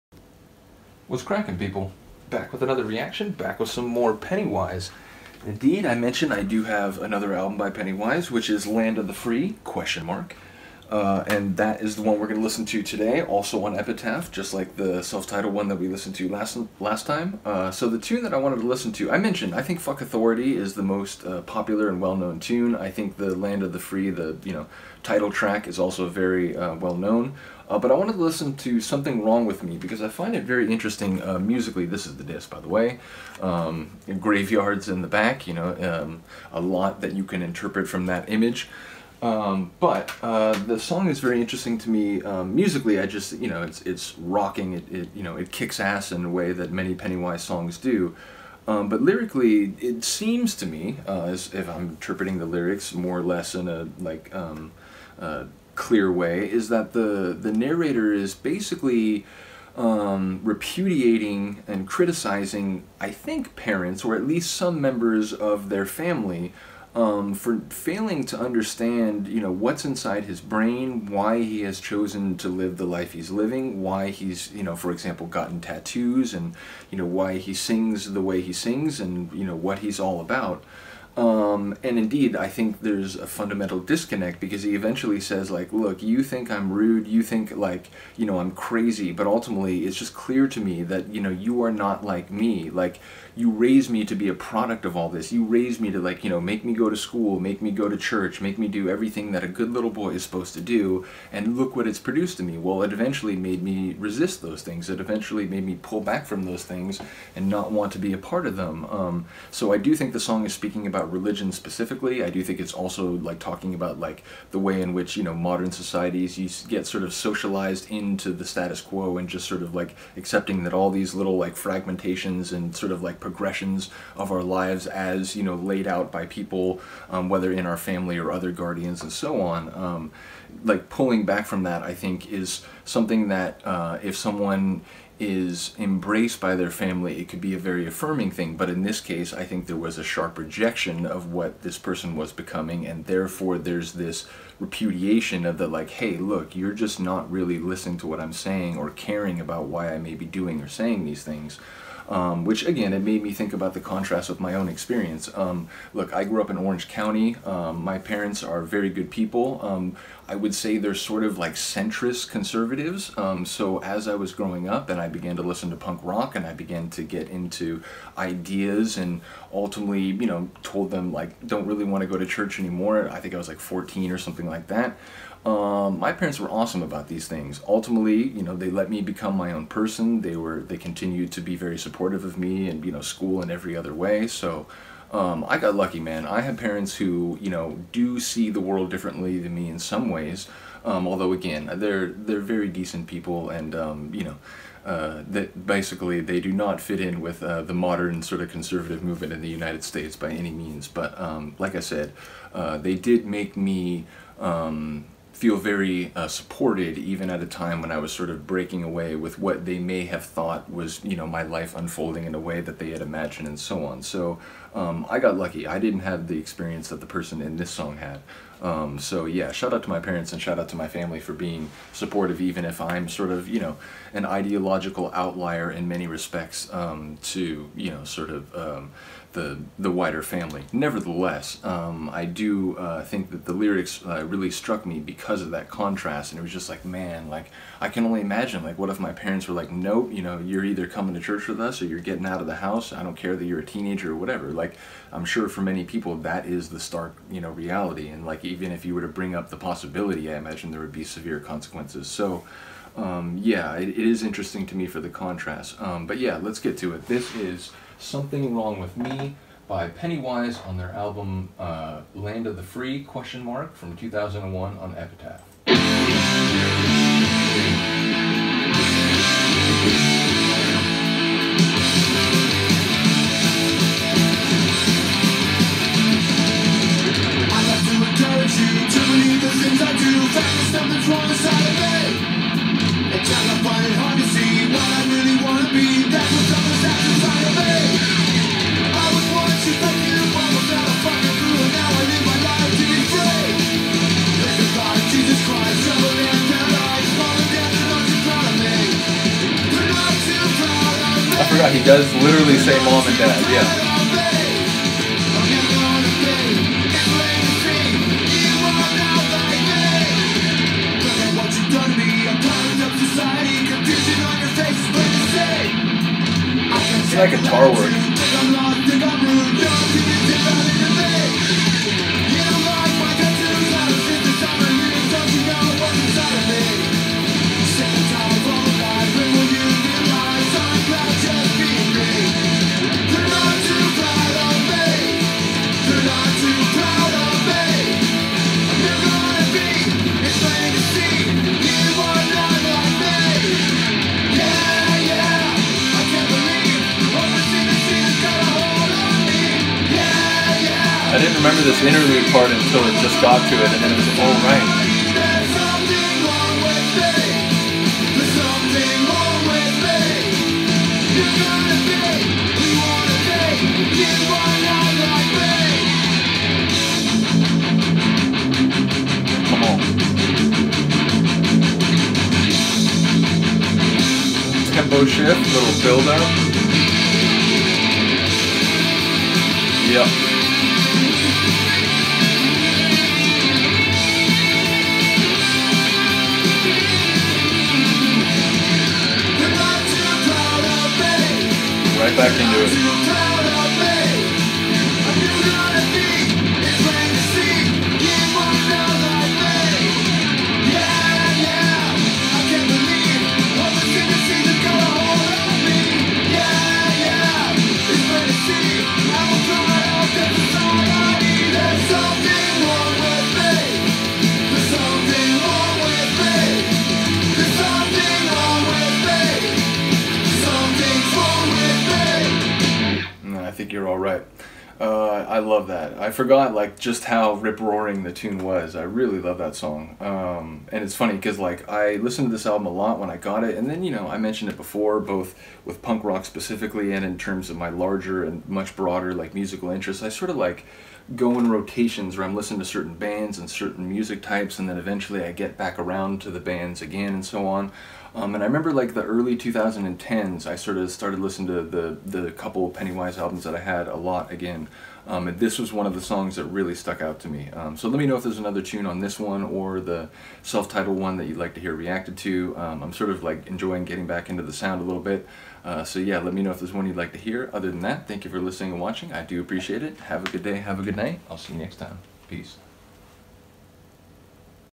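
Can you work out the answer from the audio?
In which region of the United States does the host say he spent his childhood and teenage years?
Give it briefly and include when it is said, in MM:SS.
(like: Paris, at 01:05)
Orange County, at 02:36.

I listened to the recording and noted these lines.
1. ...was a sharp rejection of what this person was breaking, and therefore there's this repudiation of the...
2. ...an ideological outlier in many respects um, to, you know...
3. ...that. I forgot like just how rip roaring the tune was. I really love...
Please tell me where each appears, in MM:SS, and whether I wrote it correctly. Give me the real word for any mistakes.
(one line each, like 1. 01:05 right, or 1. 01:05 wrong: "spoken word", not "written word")
1. 02:19 wrong: "becoming", not "breaking"
2. 03:44 right
3. 07:05 right.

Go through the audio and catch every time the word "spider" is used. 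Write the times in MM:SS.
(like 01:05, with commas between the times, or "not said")
not said.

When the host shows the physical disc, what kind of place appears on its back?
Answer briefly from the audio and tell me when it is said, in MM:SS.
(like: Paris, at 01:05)
Graveyards, at 00:34.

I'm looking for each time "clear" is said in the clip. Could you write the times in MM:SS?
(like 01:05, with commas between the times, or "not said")
00:55, 01:30.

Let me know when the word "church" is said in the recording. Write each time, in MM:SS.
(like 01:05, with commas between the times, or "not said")
01:37, 02:52, 04:01.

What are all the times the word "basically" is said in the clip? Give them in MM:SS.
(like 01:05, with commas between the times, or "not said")
00:58, 03:15.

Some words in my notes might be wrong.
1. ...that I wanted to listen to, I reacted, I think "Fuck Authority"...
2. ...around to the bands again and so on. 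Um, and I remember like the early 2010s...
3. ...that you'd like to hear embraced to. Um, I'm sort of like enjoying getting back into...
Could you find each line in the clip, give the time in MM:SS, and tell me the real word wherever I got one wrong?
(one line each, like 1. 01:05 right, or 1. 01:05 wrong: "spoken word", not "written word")
1. 00:18 wrong: "mentioned", not "reacted"
2. 07:25 right
3. 07:41 wrong: "reacted", not "embraced".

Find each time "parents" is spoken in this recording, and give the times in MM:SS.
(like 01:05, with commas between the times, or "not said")
01:03, 02:37, 02:56, 03:06, 03:39, 03:59.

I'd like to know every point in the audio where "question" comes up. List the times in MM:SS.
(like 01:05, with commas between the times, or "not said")
00:09, 04:23.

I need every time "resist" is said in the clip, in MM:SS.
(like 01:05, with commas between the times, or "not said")
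01:43.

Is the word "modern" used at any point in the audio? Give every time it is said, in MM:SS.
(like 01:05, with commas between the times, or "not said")
01:55, 03:17.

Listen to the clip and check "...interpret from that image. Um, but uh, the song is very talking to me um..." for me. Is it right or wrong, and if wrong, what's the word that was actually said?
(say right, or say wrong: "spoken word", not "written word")
wrong: "interesting", not "talking".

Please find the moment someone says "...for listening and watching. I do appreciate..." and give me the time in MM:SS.
07:48.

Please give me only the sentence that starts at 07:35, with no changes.
Um, and this was one of the songs that really stuck out to me.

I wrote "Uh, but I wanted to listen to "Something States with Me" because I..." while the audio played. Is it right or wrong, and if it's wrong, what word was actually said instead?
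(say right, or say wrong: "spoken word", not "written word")
wrong: "Wrong", not "States".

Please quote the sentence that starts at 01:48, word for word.
Um, so I do think the song is speaking about about religion specifically.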